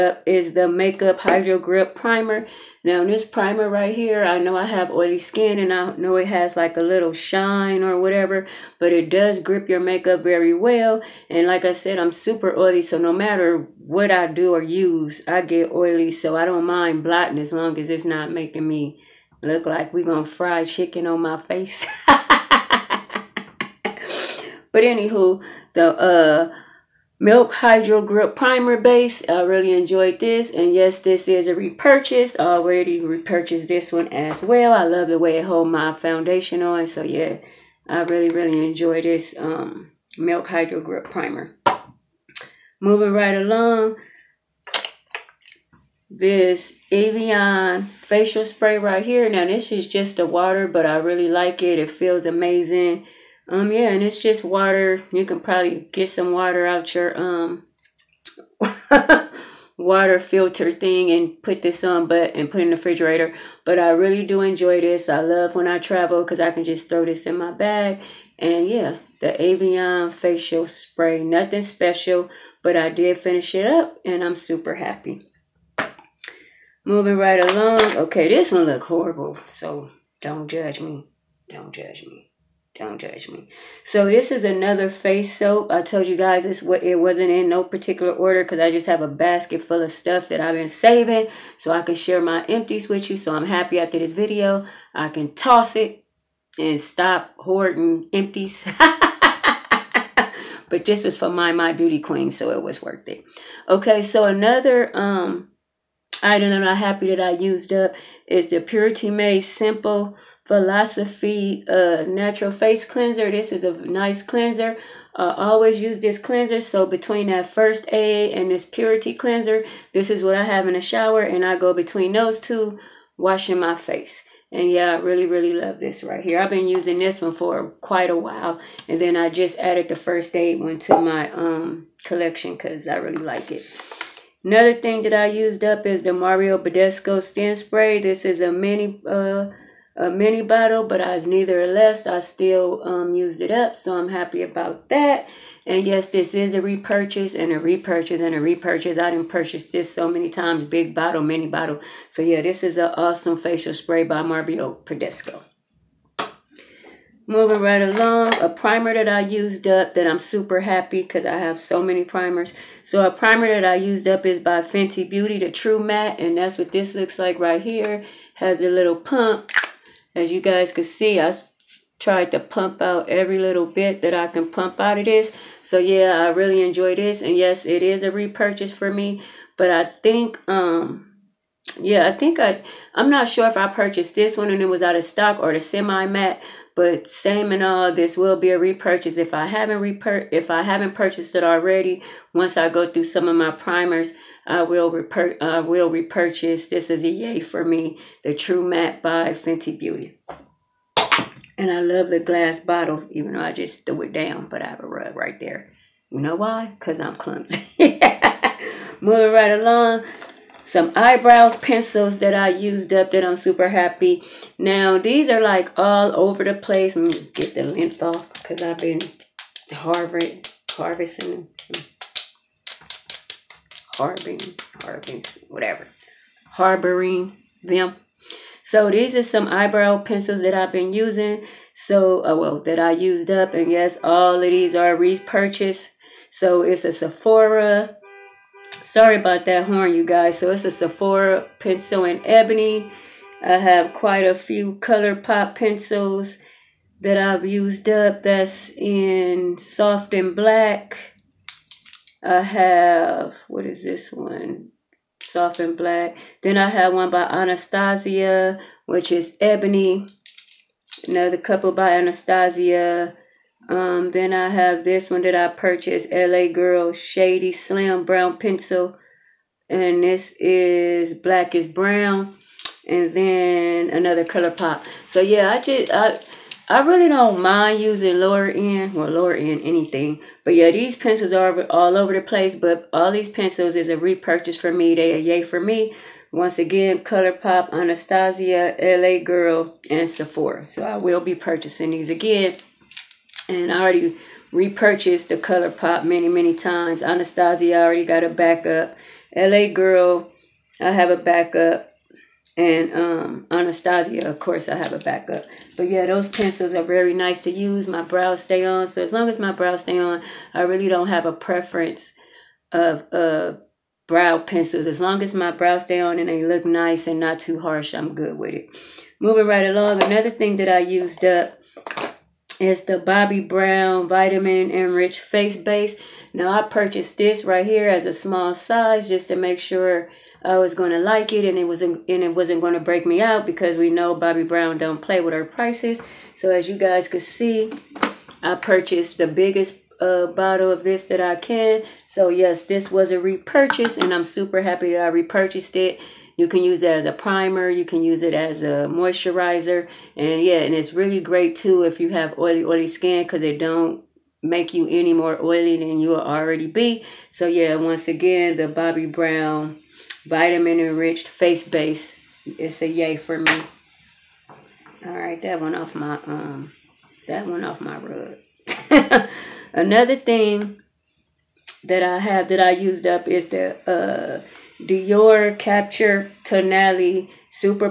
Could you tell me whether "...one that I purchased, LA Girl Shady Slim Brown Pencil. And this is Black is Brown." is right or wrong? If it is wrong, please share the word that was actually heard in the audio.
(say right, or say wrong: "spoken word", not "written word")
right.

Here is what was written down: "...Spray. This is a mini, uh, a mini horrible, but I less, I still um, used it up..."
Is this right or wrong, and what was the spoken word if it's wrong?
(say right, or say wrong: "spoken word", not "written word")
wrong: "bottle", not "horrible".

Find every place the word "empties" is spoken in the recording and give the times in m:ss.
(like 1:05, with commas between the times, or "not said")
1:32, 1:38.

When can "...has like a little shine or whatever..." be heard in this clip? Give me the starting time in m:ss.
0:06.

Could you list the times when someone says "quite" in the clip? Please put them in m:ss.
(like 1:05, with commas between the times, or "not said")
2:07, 4:03.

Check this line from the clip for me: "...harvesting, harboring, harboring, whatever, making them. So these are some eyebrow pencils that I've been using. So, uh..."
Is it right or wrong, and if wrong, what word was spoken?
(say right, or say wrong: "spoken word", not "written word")
wrong: "harboring", not "making".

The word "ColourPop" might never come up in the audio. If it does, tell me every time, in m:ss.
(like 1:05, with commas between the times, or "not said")
4:04, 4:34, 4:46, 4:55.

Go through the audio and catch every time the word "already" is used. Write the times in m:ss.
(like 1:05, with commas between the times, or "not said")
0:32, 3:11, 4:53, 4:57, 5:56.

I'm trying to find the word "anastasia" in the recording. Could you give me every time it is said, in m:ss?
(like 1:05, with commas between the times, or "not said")
4:17, 4:21, 4:47, 4:57, 5:03.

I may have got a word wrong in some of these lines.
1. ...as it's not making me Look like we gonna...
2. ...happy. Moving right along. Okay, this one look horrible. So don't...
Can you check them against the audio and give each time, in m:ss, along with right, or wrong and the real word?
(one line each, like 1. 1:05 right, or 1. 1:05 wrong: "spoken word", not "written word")
1. 0:17 right
2. 1:14 right.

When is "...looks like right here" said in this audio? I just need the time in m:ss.
2:46.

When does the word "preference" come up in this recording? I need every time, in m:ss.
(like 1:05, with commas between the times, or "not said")
5:11.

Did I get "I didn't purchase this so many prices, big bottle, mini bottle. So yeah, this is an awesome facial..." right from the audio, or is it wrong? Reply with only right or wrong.
wrong.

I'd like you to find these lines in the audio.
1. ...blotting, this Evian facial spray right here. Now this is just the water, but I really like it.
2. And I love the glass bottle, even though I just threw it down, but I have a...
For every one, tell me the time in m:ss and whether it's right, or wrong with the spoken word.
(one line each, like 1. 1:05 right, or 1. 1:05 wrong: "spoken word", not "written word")
1. 0:43 wrong: "along", not "blotting"
2. 3:21 right.